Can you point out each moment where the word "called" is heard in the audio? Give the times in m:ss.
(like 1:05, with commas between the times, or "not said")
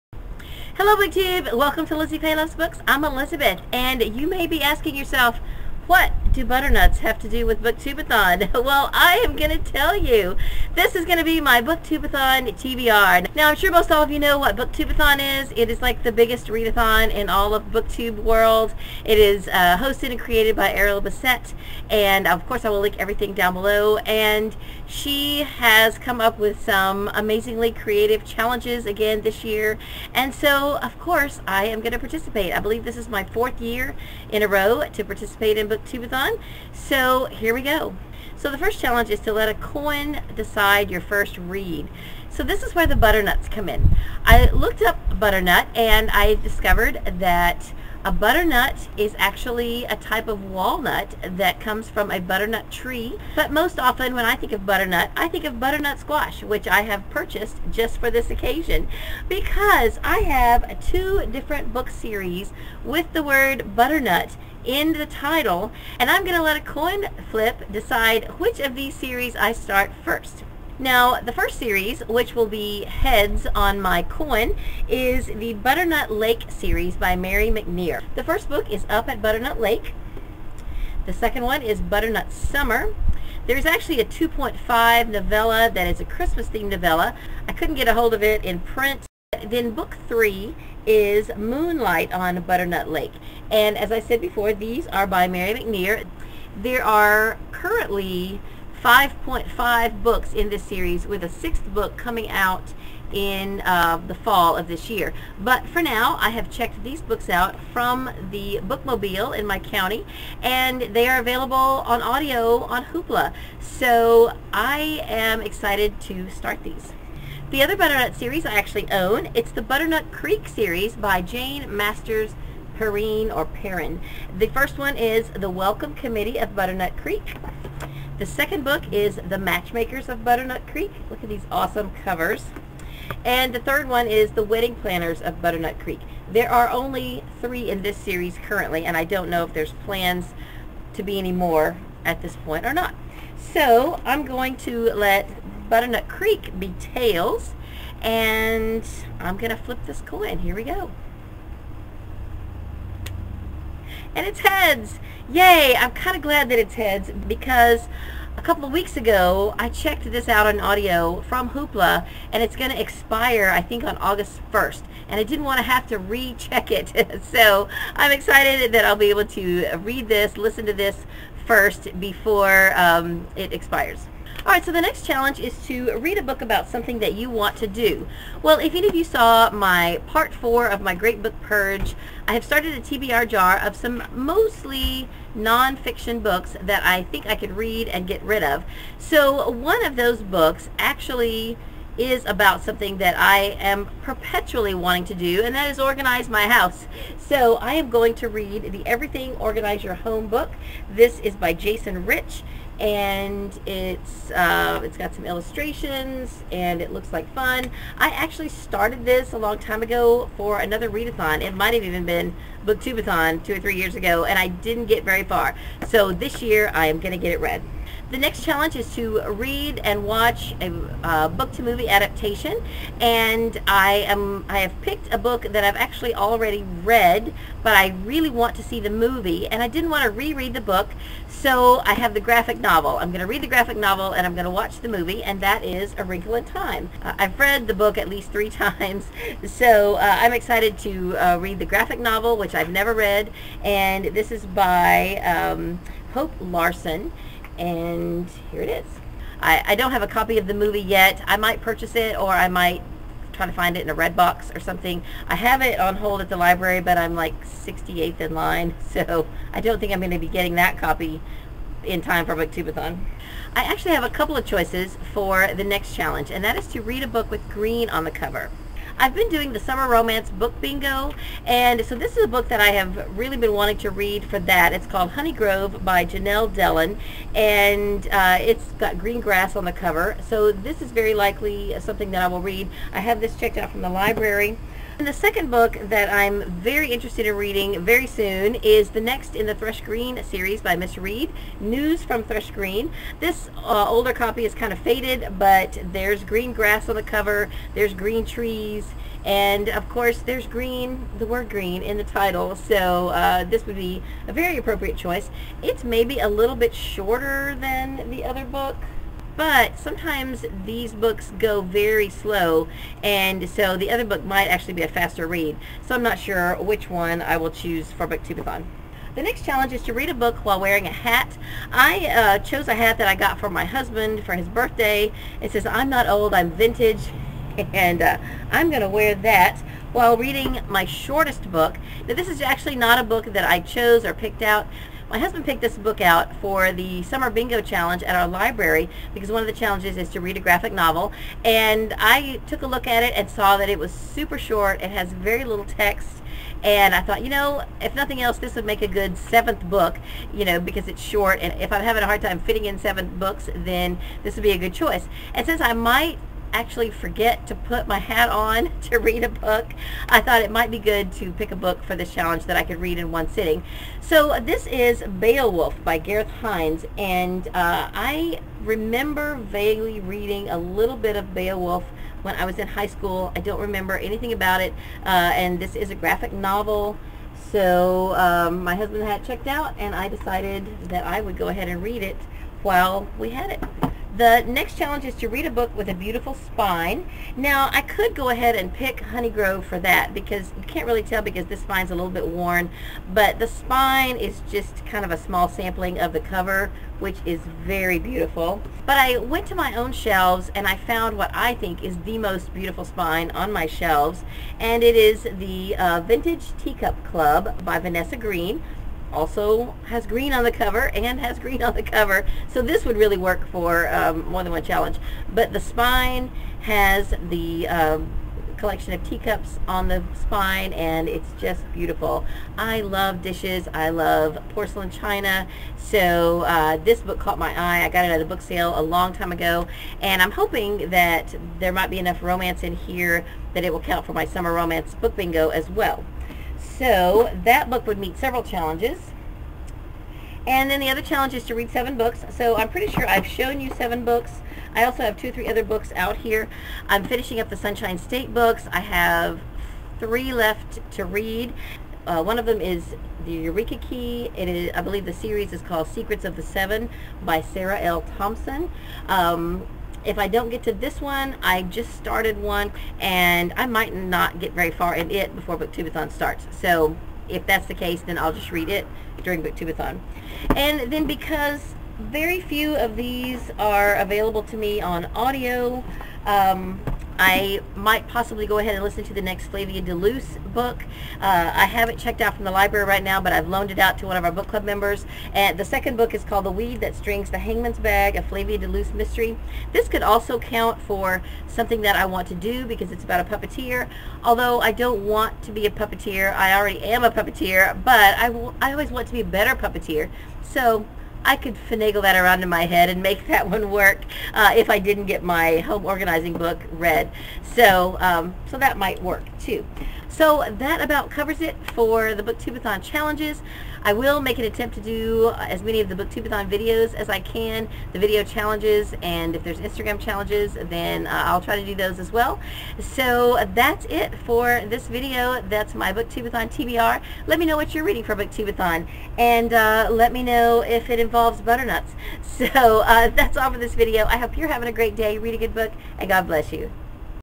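4:34, 7:35, 8:06.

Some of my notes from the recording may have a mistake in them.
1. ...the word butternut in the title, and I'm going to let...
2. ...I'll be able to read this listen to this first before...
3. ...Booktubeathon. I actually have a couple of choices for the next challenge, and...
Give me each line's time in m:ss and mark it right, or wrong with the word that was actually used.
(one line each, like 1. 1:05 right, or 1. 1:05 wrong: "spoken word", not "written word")
1. 1:03 right
2. 2:48 right
3. 4:22 right.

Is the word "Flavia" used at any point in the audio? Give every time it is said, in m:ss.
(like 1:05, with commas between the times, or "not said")
7:59, 8:08.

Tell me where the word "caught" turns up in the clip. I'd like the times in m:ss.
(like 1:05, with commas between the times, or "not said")
7:07.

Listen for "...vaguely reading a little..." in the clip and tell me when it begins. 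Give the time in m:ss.
6:09.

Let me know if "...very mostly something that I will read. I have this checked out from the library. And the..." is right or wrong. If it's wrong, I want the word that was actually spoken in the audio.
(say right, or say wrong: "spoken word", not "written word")
wrong: "likely", not "mostly".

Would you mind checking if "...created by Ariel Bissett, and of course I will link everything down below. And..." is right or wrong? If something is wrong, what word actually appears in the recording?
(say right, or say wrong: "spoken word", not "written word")
right.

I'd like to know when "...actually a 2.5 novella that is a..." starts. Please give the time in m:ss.
1:23.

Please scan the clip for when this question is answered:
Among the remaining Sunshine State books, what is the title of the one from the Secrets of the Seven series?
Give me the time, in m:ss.
7:33.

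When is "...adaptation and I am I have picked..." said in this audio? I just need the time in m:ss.
3:41.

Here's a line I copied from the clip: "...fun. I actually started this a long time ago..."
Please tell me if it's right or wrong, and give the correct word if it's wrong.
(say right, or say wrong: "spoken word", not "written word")
right.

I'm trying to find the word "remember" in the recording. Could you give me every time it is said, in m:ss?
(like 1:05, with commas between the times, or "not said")
6:08, 6:13.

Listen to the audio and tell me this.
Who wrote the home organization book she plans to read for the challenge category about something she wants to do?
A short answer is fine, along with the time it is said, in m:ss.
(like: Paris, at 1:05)
Jason Rich, at 3:21.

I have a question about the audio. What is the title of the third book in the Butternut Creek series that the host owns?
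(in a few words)
The Wedding Planners of Butternut Creek.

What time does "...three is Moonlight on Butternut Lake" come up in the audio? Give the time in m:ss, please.
1:30.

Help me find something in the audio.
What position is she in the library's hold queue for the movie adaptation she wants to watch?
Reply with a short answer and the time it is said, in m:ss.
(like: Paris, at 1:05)
68th, at 4:17.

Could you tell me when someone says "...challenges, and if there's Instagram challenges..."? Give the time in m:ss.
8:38.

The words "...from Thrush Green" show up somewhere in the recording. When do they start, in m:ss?
4:52.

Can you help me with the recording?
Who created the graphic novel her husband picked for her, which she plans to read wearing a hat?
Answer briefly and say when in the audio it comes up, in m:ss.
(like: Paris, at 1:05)
Gareth Hinds, at 6:05.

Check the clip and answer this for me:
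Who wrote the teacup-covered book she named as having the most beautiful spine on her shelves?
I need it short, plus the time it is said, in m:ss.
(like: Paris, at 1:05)
Vanessa Greene, at 6:47.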